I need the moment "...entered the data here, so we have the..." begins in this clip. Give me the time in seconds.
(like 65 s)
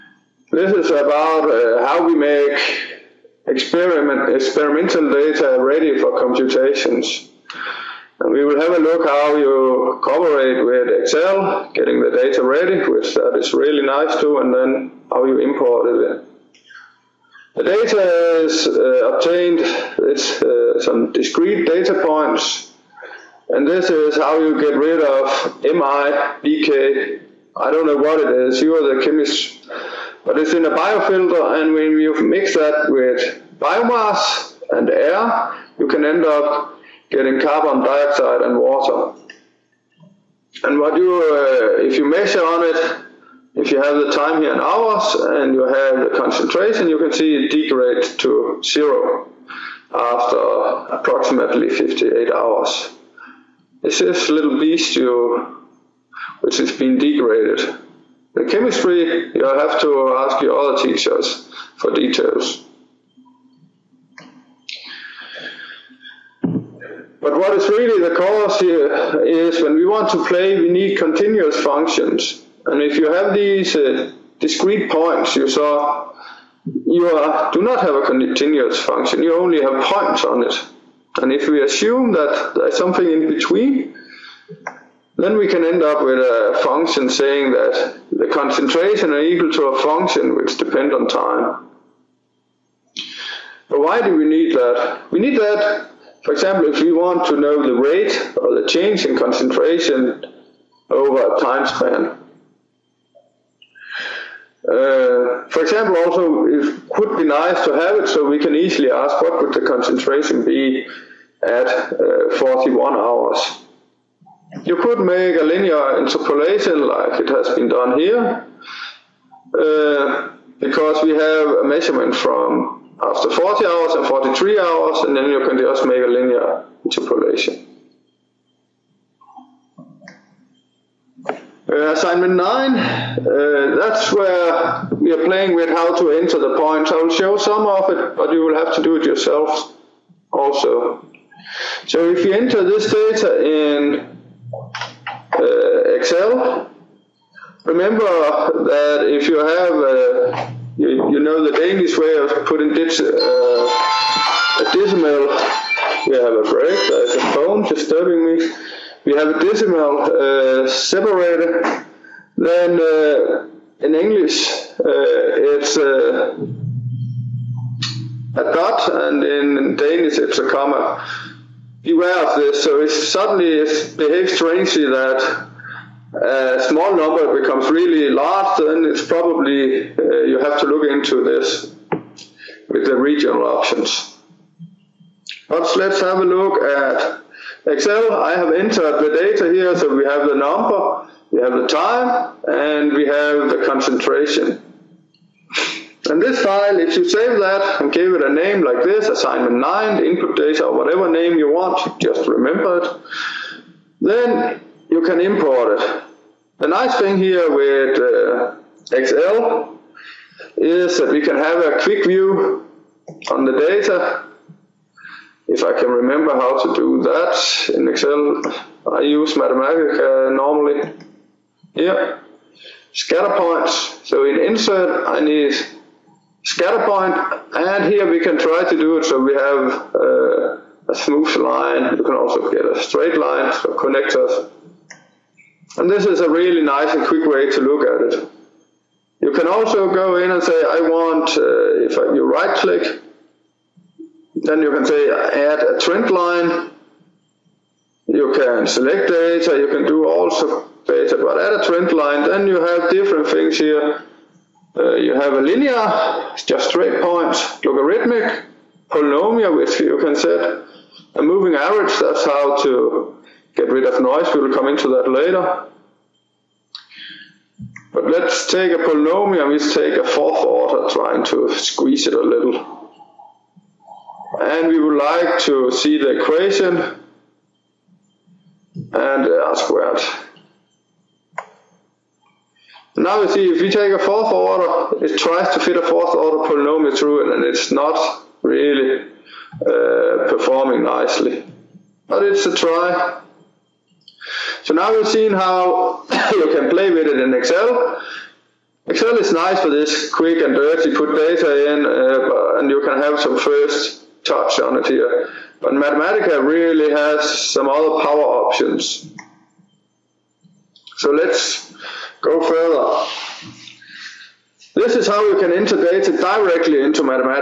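188 s.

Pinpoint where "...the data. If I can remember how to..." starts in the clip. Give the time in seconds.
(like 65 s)
213 s.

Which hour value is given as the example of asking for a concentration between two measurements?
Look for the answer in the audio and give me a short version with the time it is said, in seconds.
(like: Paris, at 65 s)
41 hours, at 112 s.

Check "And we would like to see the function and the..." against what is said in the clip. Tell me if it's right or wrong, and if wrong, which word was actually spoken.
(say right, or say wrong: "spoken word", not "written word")
wrong: "equation", not "function".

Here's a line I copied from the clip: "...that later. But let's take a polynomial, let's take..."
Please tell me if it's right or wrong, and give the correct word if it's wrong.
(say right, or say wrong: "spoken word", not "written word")
right.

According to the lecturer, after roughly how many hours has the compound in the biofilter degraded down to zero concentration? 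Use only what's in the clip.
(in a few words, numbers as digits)
58 hours.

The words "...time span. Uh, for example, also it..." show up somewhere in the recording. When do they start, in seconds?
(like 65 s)
101 s.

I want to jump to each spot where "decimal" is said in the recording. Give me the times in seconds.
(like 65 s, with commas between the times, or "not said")
154 s, 159 s.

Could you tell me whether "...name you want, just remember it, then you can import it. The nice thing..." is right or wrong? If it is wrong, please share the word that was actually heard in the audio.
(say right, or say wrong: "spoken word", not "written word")
right.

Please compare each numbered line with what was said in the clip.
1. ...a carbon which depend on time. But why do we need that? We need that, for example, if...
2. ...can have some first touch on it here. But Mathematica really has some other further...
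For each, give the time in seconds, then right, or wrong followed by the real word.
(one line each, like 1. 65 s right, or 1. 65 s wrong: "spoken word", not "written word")
1. 89 s wrong: "function", not "carbon"
2. 302 s wrong: "power", not "further".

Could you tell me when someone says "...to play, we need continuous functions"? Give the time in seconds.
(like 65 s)
70 s.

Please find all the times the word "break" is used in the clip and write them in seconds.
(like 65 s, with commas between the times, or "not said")
156 s.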